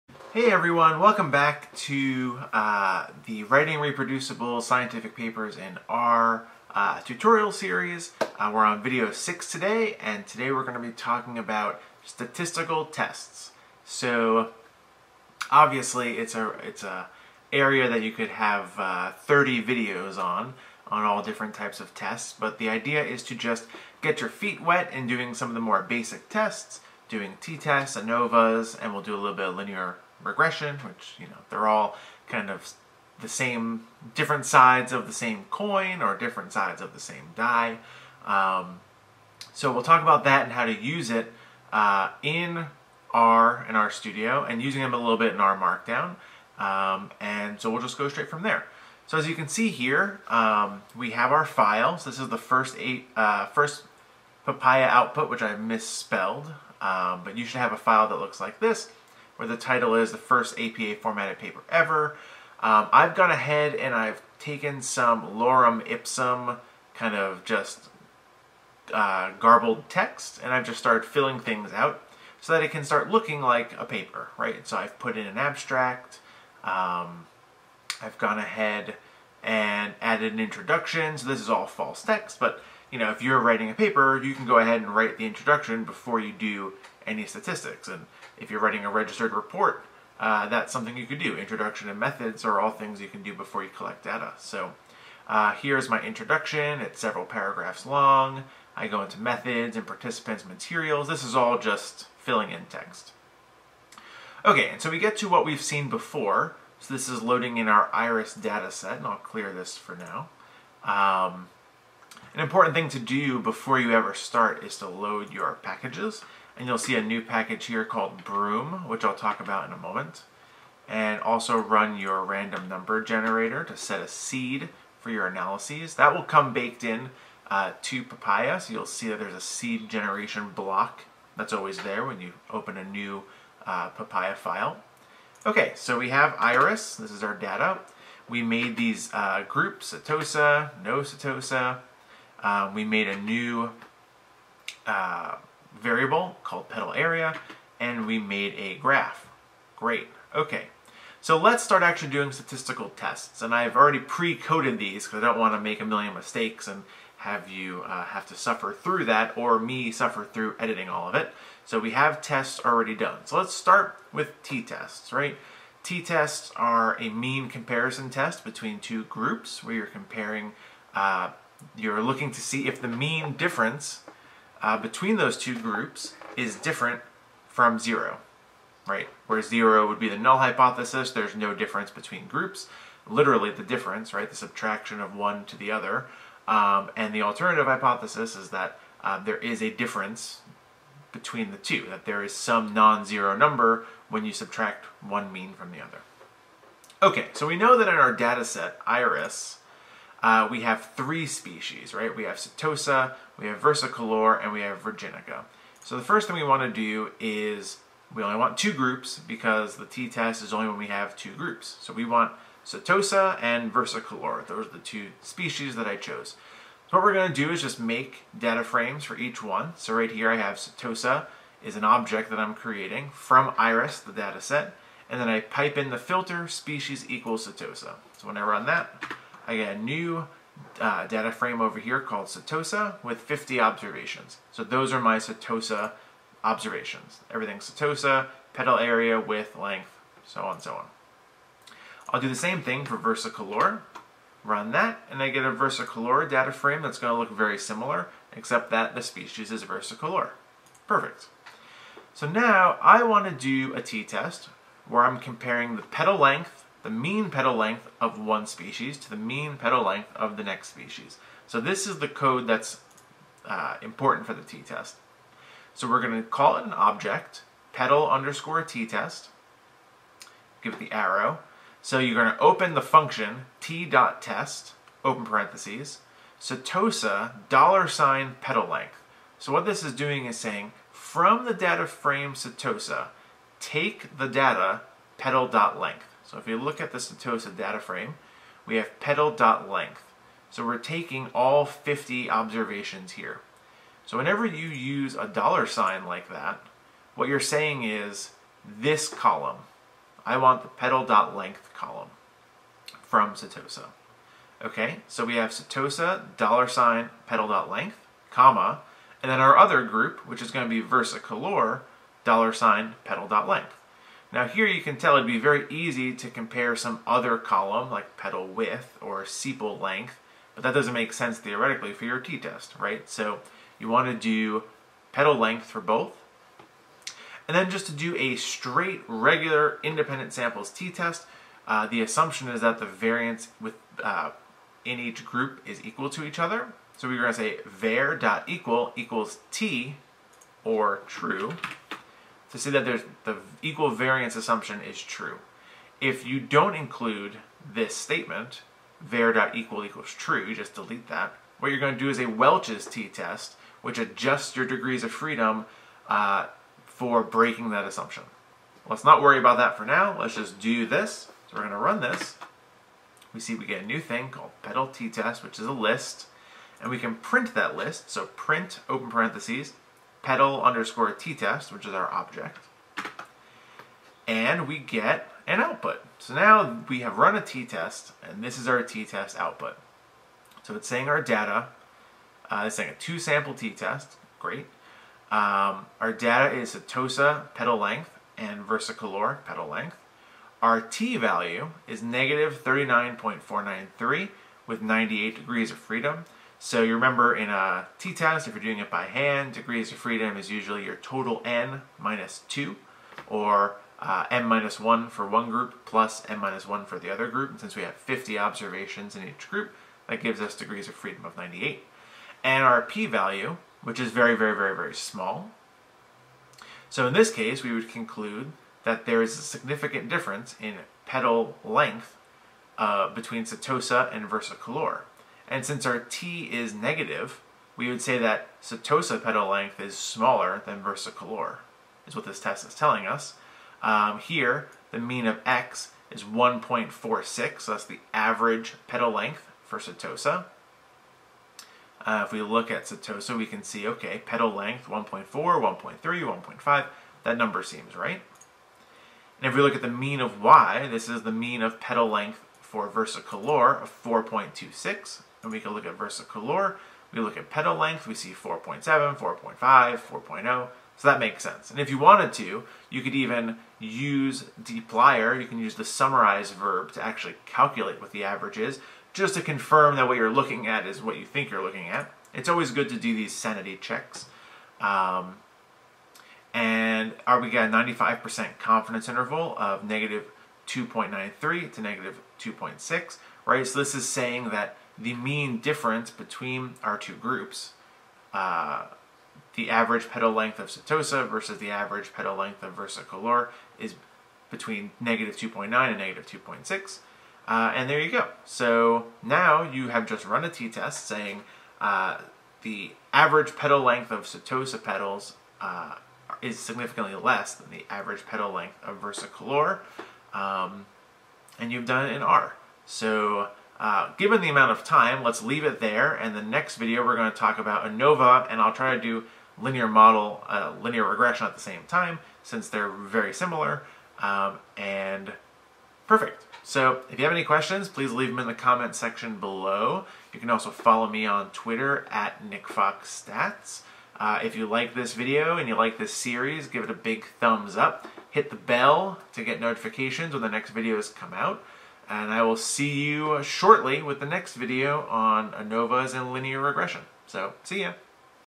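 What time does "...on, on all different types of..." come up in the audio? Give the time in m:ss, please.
0:20.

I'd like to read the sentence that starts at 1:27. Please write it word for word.
And if you're writing a registered report, uh, that's something you could do.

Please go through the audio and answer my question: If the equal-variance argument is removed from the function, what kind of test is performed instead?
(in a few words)
Welch's t-test.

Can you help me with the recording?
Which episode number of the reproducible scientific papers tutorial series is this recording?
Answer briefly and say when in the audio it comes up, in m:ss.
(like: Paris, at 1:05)
6, at 0:08.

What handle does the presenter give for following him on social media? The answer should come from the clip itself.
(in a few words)
NickFoxStats.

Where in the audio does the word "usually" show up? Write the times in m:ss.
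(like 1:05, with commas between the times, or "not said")
6:40.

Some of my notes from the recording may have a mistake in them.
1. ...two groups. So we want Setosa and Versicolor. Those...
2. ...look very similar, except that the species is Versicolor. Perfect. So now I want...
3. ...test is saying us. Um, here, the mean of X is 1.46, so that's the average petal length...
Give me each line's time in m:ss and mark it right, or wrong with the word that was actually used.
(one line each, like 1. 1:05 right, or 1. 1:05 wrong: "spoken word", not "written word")
1. 3:31 right
2. 4:07 right
3. 7:12 wrong: "telling", not "saying".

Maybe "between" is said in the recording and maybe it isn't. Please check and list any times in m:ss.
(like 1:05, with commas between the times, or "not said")
2:48, 2:54, 3:01, 3:11, 7:03, 8:06, 8:14.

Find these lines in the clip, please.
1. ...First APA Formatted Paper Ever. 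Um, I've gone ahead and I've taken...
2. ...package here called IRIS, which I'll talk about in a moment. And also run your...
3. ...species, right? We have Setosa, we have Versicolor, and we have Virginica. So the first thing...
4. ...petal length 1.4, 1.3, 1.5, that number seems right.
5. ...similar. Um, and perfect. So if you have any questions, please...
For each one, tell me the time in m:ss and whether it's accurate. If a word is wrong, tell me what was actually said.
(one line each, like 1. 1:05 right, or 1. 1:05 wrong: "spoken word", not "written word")
1. 1:00 right
2. 1:57 wrong: "Broom", not "IRIS"
3. 3:21 right
4. 7:24 right
5. 8:43 right.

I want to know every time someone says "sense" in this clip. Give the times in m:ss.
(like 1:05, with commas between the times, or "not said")
5:21, 7:41.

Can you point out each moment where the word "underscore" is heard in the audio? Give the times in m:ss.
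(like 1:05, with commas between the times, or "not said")
4:28, 6:10.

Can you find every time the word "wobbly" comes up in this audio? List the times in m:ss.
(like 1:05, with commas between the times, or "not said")
not said.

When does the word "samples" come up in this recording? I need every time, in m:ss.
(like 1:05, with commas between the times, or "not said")
5:30, 6:23.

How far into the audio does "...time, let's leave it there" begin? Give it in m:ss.
8:34.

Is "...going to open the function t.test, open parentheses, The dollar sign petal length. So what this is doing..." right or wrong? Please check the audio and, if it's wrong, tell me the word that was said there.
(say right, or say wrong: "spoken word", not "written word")
wrong: "Setosa", not "The".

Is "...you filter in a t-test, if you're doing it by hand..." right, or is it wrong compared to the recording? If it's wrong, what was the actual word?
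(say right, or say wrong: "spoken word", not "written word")
wrong: "remember", not "filter".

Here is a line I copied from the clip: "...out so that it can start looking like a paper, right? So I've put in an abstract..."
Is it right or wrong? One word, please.
right.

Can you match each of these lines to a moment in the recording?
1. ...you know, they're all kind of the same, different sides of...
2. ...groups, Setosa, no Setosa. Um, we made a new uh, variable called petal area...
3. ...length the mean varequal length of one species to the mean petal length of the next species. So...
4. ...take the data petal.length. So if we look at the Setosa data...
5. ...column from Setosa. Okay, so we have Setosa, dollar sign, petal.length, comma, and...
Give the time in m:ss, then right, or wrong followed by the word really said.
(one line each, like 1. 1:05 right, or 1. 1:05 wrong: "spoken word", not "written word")
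1. 0:31 right
2. 2:19 right
3. 4:16 wrong: "petal", not "varequal"
4. 4:43 right
5. 5:01 right.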